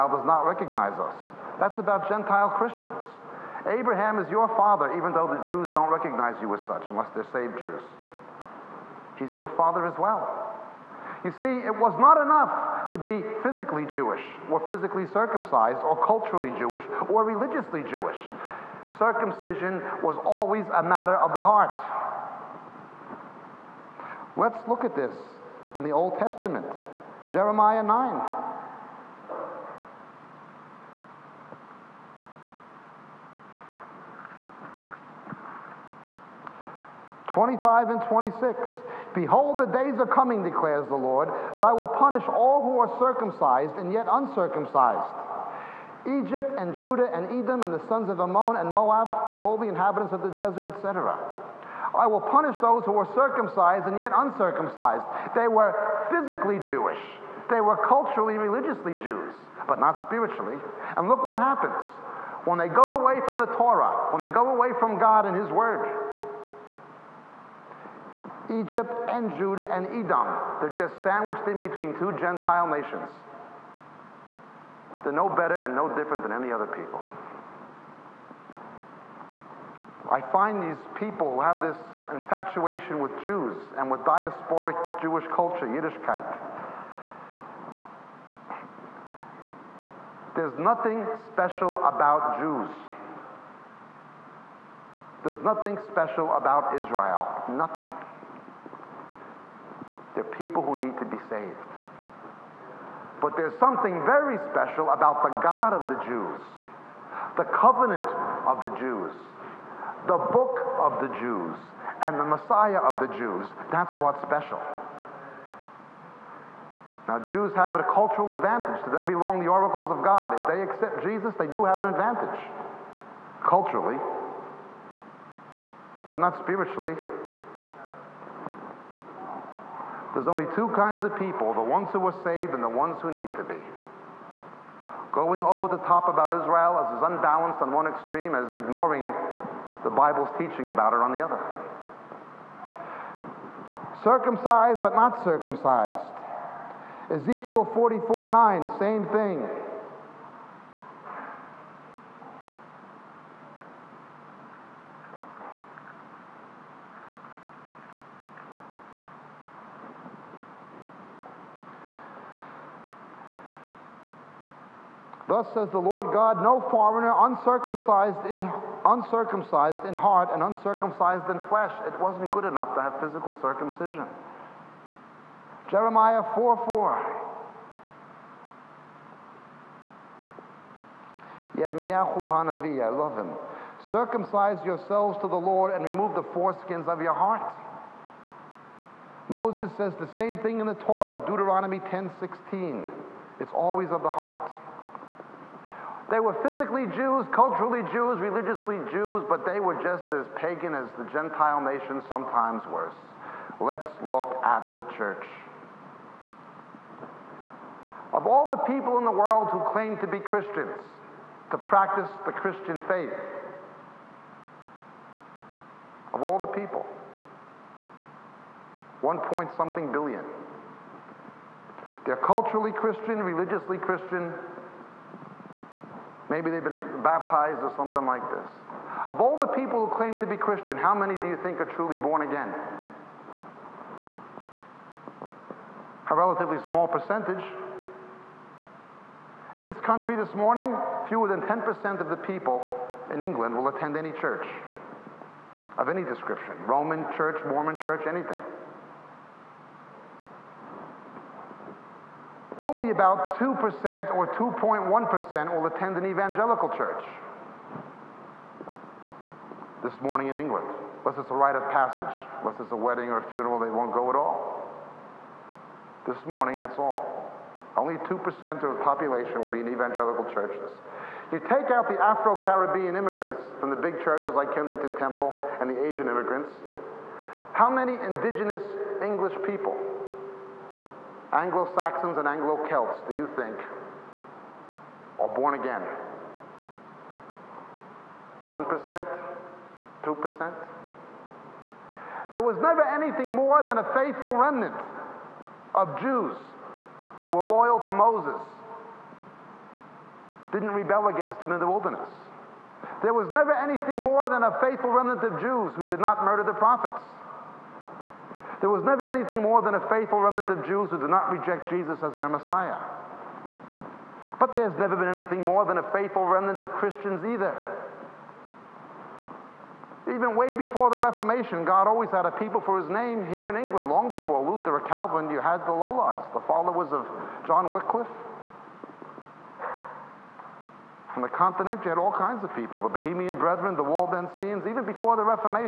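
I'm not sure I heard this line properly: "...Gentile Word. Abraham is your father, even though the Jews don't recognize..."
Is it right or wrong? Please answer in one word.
wrong.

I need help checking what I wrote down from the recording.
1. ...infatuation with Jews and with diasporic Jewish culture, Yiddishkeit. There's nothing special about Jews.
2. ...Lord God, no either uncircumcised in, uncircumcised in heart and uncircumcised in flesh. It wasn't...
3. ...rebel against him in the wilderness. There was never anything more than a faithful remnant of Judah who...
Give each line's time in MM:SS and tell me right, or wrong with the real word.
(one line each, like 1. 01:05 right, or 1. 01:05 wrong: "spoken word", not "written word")
1. 01:22 right
2. 02:45 wrong: "foreigner", not "either"
3. 05:00 wrong: "Jews", not "Judah".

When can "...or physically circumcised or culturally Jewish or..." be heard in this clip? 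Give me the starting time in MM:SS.
00:14.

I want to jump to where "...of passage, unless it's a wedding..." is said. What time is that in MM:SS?
04:21.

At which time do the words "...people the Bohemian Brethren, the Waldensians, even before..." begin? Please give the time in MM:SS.
05:32.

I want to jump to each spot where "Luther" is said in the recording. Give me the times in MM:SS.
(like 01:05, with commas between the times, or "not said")
05:24.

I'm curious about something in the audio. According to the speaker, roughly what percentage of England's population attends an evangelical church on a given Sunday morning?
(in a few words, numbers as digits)
2.1%.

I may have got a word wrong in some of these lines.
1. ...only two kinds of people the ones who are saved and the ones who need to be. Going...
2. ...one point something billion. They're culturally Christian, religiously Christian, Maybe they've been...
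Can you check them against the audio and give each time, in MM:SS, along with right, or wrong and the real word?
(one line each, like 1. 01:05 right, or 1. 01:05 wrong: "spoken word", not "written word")
1. 02:10 right
2. 03:39 right.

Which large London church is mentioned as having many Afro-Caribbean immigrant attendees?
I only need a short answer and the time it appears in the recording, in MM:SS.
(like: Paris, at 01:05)
Kensington Temple, at 04:34.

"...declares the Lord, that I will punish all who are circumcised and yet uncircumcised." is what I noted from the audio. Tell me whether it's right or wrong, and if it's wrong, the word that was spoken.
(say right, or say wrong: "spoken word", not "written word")
right.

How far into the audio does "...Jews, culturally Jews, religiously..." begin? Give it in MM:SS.
03:16.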